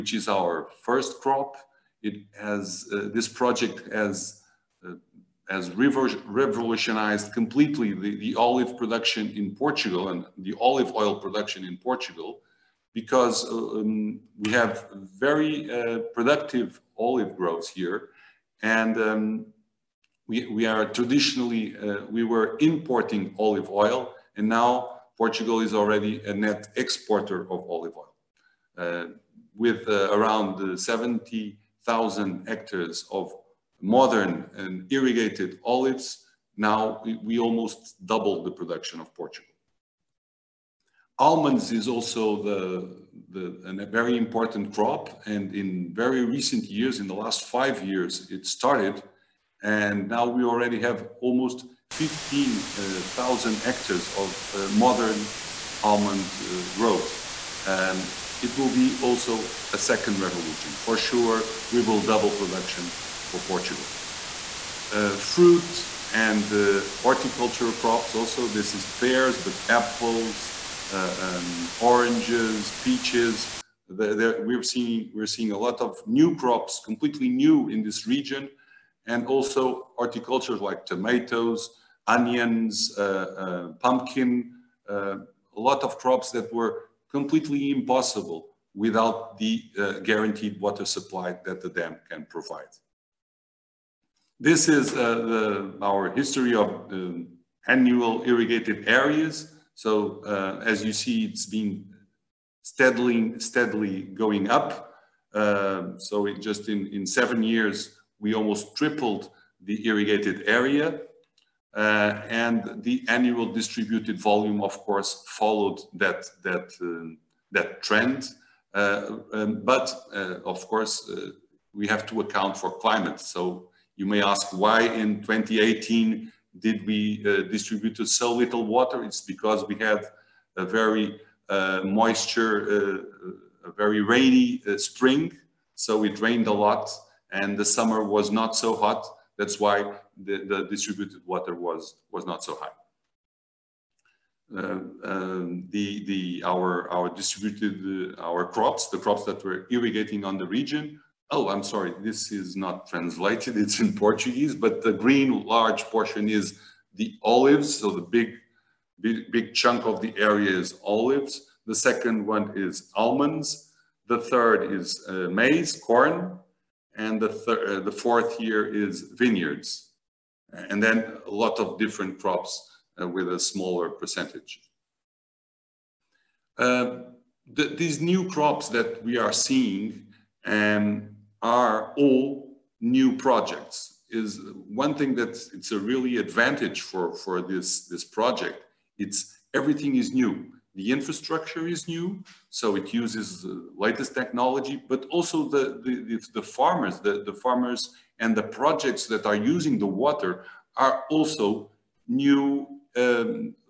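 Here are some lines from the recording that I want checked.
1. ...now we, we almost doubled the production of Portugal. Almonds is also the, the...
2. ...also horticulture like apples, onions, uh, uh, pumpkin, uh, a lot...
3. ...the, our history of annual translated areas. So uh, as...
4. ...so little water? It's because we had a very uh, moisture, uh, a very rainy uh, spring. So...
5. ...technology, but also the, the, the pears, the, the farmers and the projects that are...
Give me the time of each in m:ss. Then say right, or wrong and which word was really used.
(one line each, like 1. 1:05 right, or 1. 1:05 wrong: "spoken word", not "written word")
1. 0:36 right
2. 1:19 wrong: "tomatoes", not "apples"
3. 1:35 wrong: "irrigated", not "translated"
4. 2:08 right
5. 3:14 wrong: "farmers", not "pears".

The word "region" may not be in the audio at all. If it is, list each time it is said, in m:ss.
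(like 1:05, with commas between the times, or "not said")
1:18, 2:30.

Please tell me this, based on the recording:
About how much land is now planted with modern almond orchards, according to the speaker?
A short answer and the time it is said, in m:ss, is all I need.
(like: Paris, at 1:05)
15,000 hectares, at 0:51.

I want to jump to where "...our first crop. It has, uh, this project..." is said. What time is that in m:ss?
0:00.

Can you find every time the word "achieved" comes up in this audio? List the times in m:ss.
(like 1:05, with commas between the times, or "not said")
not said.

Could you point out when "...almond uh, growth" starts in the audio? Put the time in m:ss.
0:55.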